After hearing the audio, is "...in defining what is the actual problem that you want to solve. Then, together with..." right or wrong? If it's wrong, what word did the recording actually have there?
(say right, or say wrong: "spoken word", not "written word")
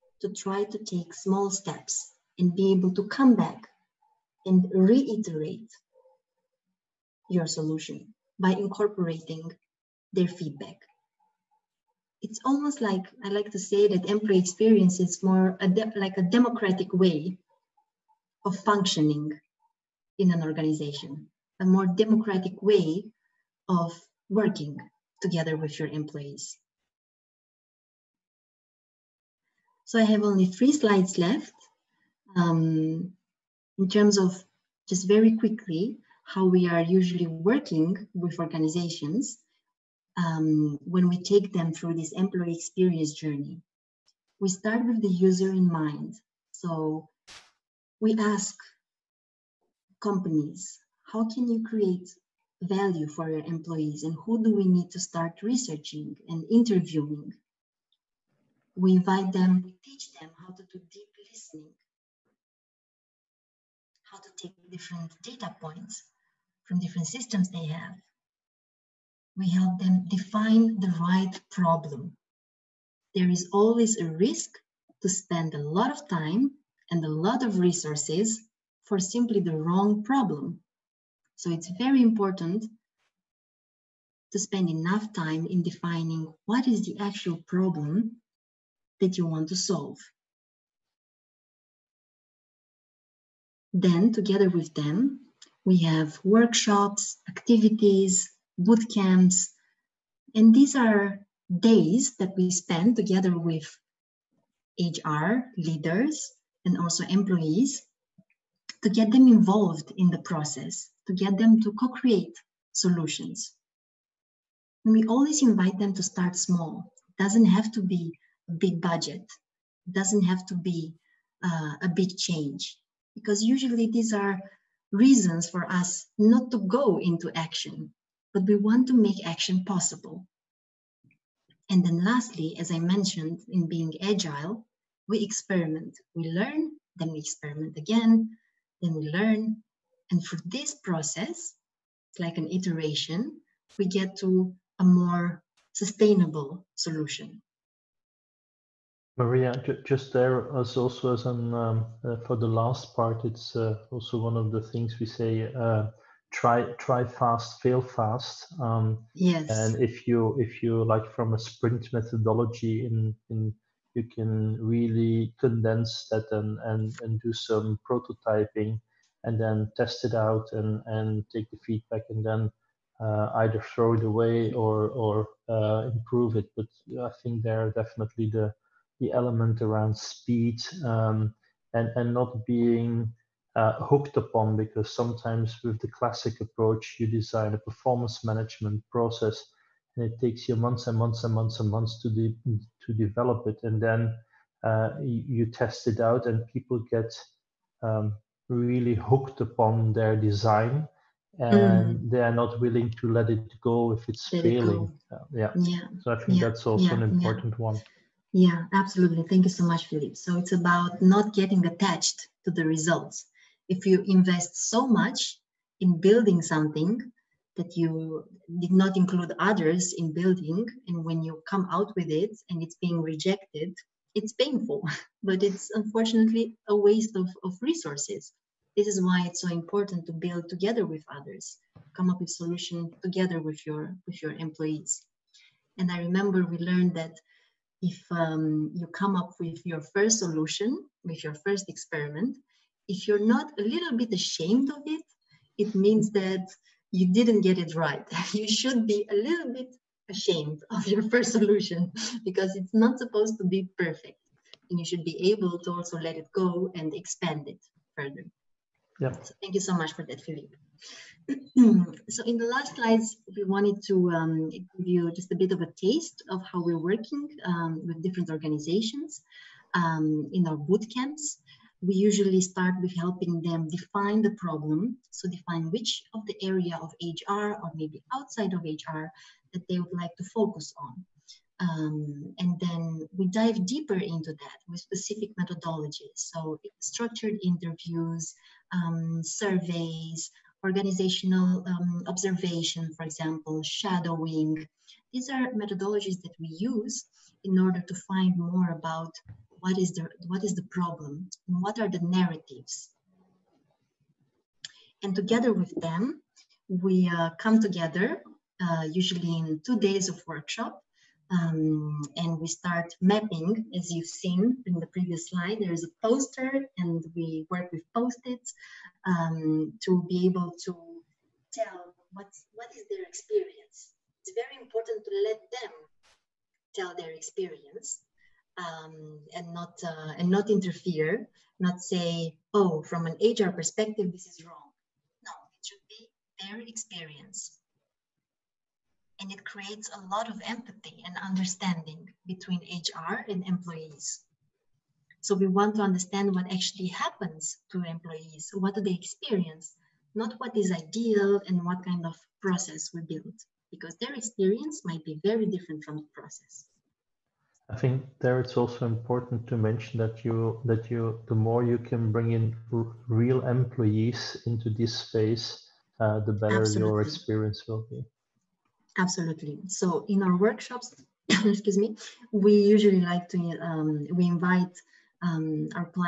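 right.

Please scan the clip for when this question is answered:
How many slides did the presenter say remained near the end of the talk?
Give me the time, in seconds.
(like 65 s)
30 s.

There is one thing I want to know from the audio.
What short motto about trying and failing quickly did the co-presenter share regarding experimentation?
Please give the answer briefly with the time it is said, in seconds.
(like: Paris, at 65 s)
try fast, fail fast, at 156 s.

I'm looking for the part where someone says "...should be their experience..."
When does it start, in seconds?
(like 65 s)
335 s.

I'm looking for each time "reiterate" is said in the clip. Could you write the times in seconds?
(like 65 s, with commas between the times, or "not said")
4 s.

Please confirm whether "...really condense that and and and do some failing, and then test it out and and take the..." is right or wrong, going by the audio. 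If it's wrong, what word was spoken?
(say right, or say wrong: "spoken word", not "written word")
wrong: "prototyping", not "failing".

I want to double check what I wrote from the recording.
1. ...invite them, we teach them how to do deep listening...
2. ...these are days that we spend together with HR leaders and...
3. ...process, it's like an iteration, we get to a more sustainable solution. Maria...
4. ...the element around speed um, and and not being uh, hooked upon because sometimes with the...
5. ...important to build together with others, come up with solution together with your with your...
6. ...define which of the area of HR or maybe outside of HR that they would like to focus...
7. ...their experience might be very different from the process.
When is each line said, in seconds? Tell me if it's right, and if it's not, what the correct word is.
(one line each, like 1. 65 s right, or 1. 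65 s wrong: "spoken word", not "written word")
1. 58 s right
2. 100 s right
3. 140 s right
4. 178 s right
5. 229 s right
6. 275 s right
7. 353 s right.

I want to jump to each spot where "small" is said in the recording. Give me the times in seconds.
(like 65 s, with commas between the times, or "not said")
1 s, 116 s.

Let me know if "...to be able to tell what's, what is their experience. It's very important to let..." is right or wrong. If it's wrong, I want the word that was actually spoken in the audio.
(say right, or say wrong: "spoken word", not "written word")
right.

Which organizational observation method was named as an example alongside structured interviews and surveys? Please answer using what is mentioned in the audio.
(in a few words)
shadowing.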